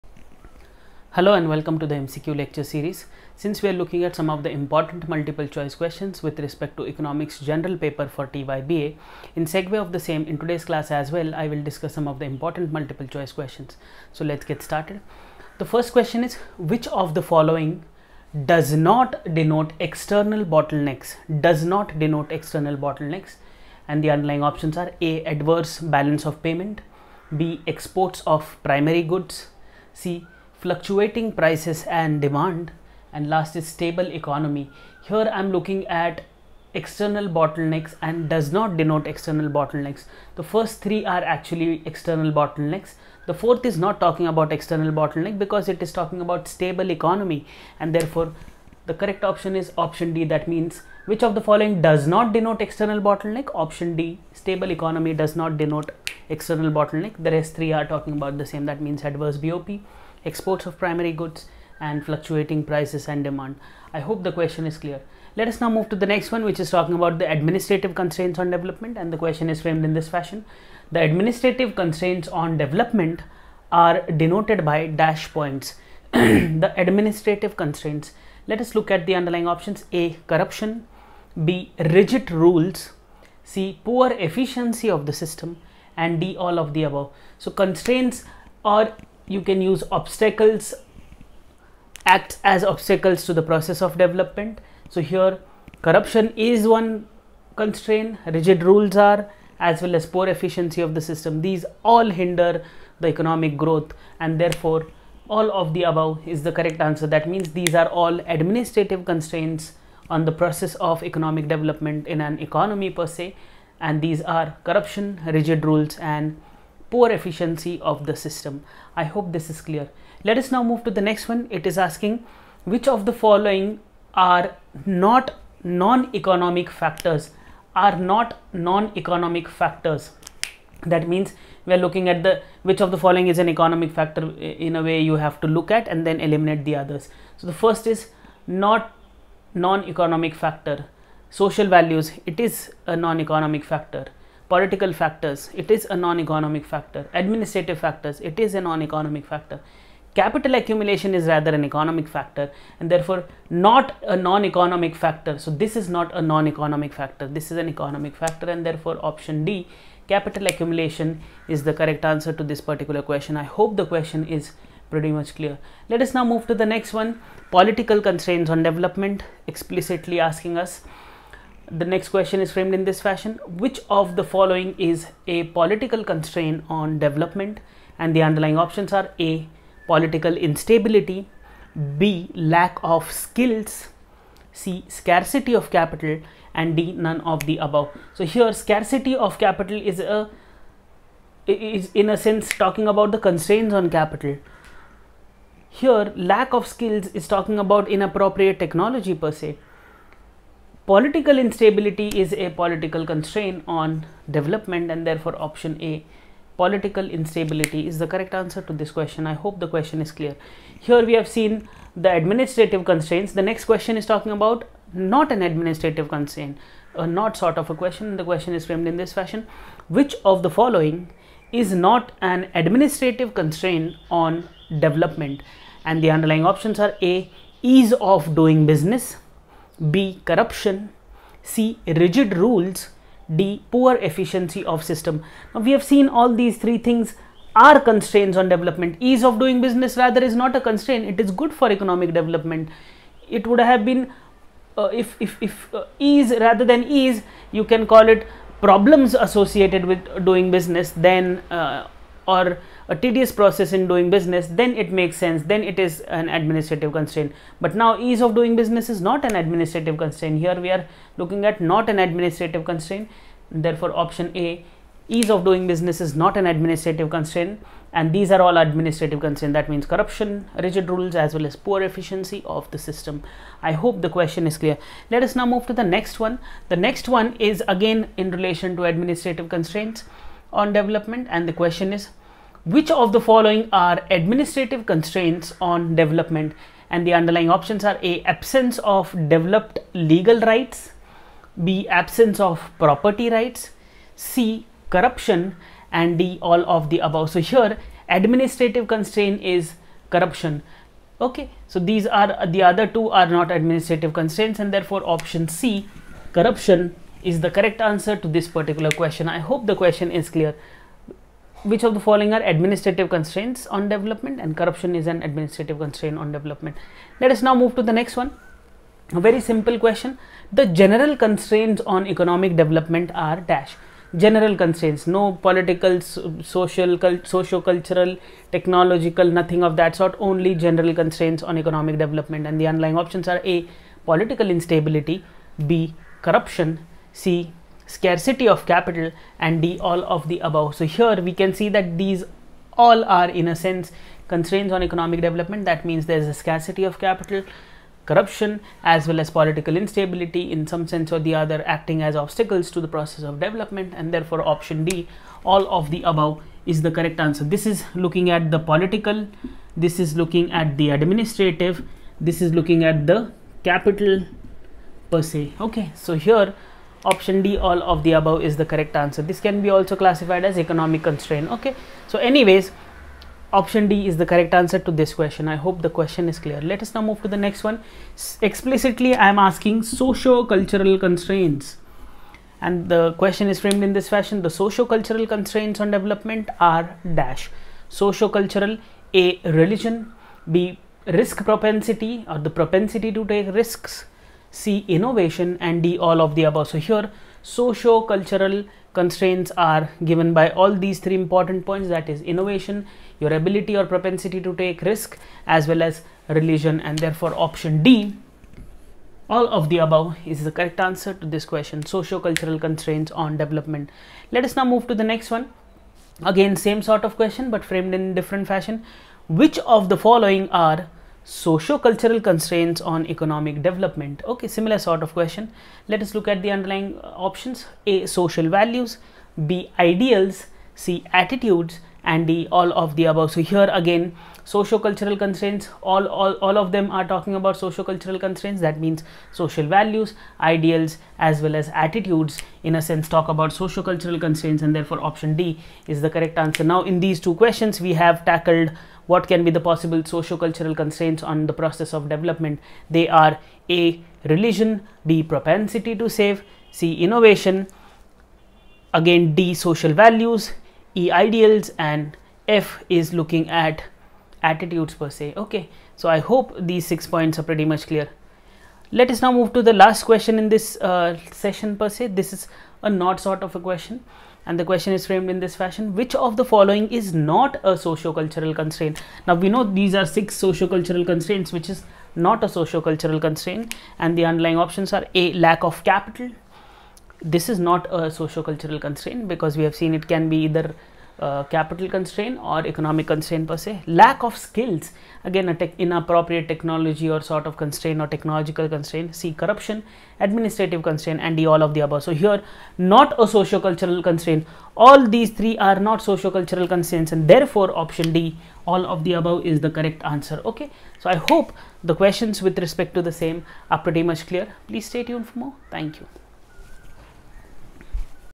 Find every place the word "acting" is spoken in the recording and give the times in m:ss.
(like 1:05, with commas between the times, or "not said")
5:51.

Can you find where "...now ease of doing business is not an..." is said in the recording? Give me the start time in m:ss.
4:17.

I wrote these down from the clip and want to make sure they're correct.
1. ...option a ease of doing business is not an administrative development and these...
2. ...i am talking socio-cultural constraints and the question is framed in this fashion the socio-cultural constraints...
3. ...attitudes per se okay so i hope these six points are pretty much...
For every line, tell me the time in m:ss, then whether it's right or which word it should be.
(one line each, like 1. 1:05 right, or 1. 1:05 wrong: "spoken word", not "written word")
1. 4:24 wrong: "constraint", not "development"
2. 6:19 wrong: "asking", not "talking"
3. 7:44 right.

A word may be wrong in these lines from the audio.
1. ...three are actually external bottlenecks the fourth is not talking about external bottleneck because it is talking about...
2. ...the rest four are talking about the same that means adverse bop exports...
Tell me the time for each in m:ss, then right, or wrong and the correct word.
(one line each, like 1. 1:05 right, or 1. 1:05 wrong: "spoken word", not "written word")
1. 0:40 right
2. 0:57 wrong: "three", not "four".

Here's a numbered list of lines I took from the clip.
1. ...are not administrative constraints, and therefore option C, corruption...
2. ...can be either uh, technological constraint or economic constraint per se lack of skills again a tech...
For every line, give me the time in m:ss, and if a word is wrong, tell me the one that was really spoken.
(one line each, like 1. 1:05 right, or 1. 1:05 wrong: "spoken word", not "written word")
1. 5:03 right
2. 8:10 wrong: "capital", not "technological".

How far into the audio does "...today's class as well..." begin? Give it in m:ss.
0:10.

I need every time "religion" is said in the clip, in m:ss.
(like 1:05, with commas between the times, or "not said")
6:29, 6:46, 7:34.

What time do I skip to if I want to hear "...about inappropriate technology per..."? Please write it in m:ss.
3:17.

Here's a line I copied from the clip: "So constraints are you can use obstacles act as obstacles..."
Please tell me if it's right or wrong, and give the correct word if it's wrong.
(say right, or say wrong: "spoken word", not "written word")
right.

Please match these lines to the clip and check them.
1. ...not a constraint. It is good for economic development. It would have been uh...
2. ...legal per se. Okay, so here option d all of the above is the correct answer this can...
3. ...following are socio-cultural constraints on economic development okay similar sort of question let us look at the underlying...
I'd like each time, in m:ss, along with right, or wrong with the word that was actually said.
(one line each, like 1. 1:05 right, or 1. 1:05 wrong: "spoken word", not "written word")
1. 4:00 right
2. 6:03 wrong: "capital", not "legal"
3. 6:59 right.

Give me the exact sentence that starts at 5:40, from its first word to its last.
So here we can see that these all are in a sense constraints on economic development.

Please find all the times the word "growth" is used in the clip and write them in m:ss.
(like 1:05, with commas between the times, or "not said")
1:43.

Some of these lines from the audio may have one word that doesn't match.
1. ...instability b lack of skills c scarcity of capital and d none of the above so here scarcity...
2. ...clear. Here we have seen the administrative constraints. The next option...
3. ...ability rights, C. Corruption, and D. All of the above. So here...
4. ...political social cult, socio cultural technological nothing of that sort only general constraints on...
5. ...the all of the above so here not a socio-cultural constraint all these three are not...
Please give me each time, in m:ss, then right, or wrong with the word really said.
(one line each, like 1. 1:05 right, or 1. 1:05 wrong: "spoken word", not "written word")
1. 3:00 right
2. 3:30 wrong: "question", not "option"
3. 4:52 wrong: "property", not "ability"
4. 5:25 right
5. 8:21 right.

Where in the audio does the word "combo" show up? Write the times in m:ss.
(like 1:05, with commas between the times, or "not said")
not said.